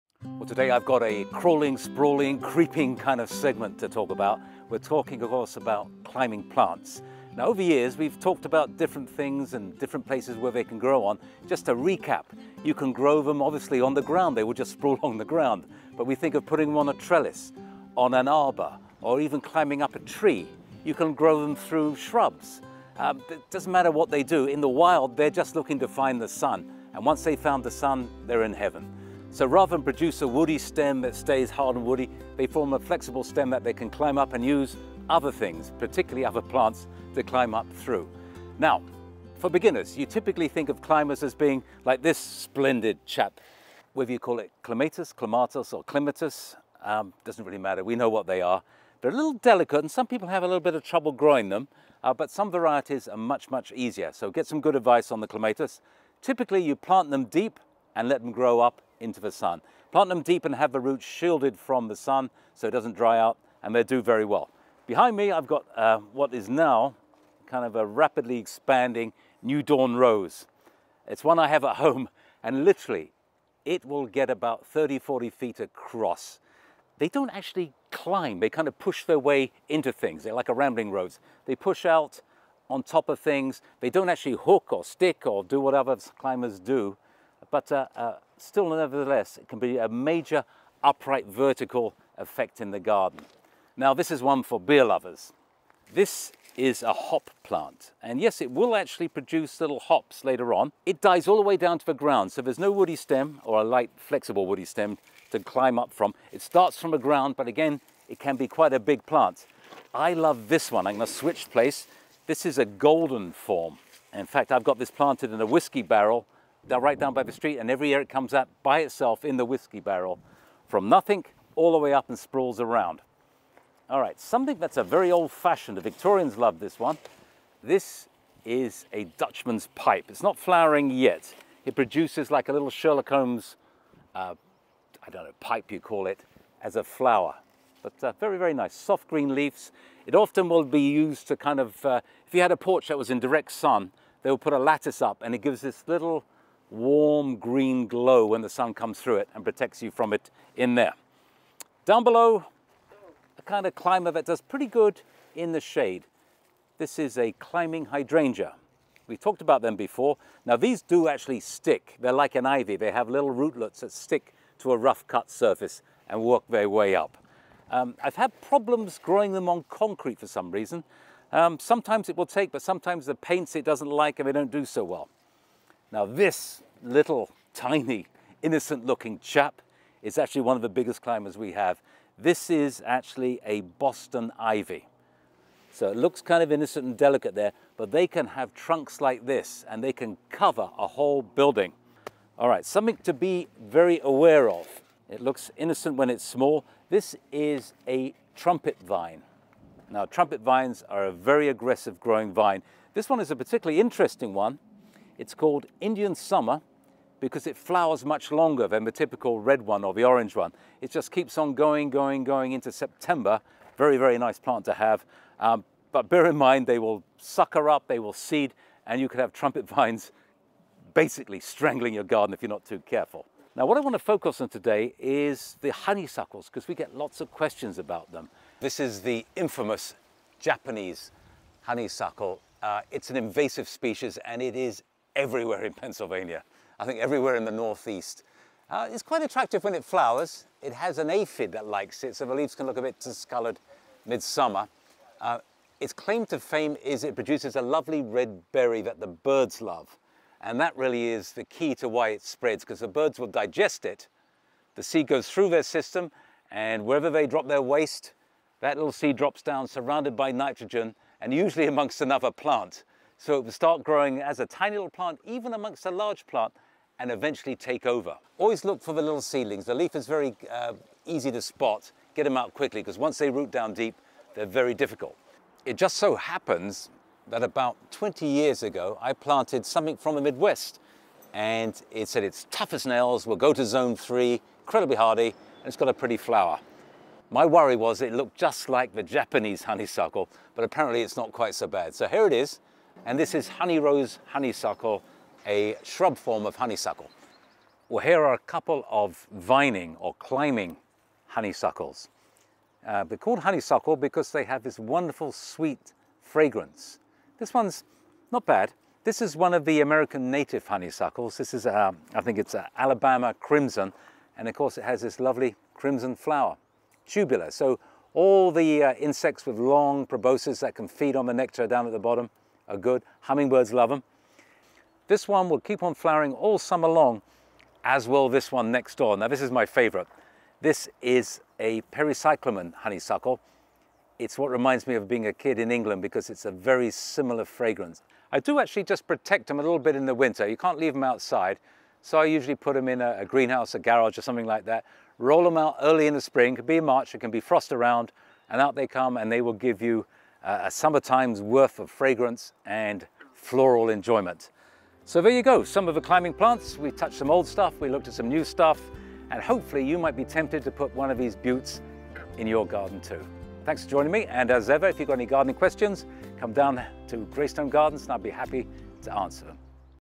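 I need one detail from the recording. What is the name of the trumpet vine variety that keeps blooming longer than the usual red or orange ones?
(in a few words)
Indian Summer.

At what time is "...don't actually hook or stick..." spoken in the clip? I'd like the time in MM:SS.
01:23.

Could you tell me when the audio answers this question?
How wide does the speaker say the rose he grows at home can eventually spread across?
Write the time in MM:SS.
01:14.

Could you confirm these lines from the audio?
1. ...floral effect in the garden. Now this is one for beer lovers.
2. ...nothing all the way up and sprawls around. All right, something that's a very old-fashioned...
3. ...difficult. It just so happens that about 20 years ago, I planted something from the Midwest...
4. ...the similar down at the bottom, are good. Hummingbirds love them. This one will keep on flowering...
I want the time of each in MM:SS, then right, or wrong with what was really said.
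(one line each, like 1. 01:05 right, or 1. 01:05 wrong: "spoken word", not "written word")
1. 01:31 wrong: "vertical", not "floral"
2. 02:00 right
3. 04:34 right
4. 05:21 wrong: "nectar", not "similar".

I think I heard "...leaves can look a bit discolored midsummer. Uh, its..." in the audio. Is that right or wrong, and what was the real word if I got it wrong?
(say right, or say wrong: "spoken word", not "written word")
right.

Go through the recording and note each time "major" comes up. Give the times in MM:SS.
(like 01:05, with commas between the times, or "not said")
01:29.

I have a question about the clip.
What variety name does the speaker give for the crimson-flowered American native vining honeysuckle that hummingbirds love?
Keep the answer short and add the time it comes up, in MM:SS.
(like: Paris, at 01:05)
Alabama crimson, at 05:12.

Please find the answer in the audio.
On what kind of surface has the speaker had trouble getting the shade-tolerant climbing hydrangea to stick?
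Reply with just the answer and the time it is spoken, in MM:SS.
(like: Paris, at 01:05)
concrete, at 02:49.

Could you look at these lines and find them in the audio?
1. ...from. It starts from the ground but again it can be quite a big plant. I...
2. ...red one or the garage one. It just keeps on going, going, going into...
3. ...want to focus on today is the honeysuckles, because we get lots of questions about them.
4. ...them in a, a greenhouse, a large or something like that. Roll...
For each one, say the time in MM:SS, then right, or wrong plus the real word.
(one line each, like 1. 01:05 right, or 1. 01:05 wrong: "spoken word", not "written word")
1. 01:45 right
2. 03:29 wrong: "orange", not "garage"
3. 03:43 right
4. 05:42 wrong: "garage", not "large".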